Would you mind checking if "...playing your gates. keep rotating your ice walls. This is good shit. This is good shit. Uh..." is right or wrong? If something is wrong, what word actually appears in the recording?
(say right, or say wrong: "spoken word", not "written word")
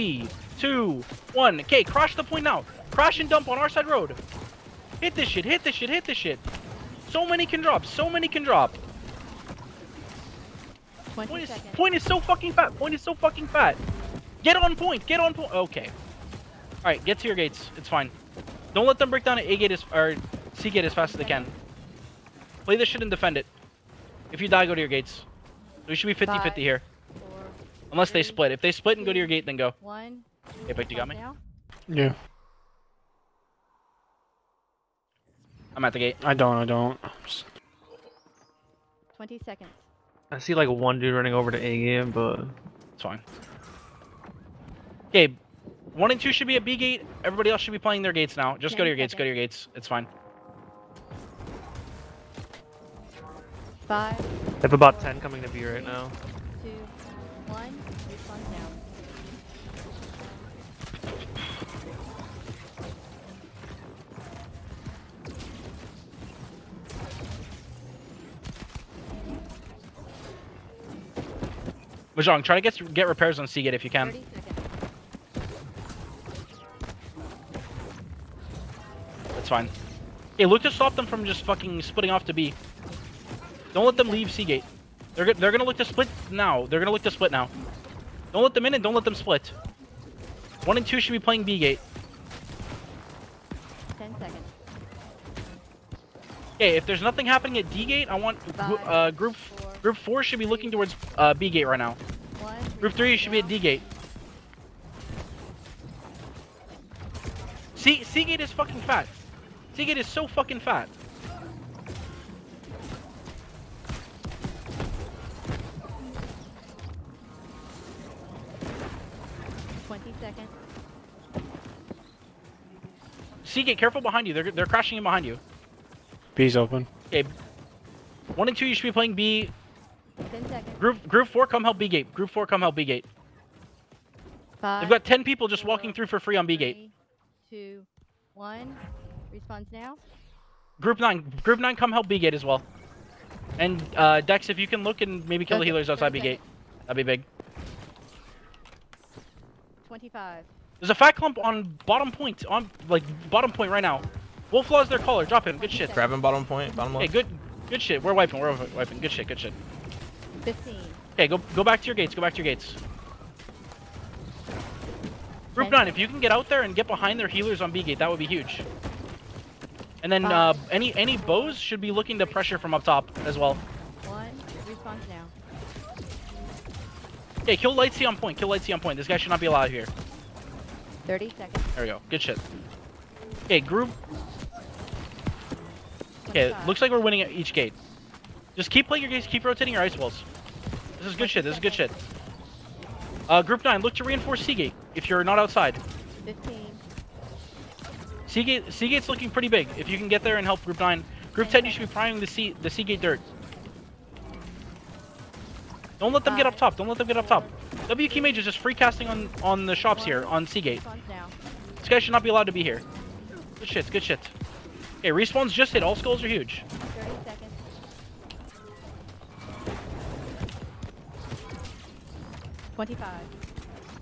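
right.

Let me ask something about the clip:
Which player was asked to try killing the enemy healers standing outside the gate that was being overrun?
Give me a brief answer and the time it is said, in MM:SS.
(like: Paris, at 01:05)
Dex, at 02:24.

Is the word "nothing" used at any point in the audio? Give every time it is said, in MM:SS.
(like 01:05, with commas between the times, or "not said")
01:37.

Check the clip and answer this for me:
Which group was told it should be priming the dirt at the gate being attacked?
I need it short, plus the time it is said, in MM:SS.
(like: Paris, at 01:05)
Group 10, at 03:21.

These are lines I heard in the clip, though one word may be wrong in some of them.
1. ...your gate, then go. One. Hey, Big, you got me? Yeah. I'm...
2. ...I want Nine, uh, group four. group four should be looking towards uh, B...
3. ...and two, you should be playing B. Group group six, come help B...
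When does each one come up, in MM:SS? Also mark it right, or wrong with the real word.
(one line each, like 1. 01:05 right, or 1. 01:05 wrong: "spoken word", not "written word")
1. 00:29 right
2. 01:38 wrong: "Five", not "Nine"
3. 02:08 wrong: "four", not "six".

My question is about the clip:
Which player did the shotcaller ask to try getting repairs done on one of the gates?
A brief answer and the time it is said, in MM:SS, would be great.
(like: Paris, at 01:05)
Mahjong, at 01:12.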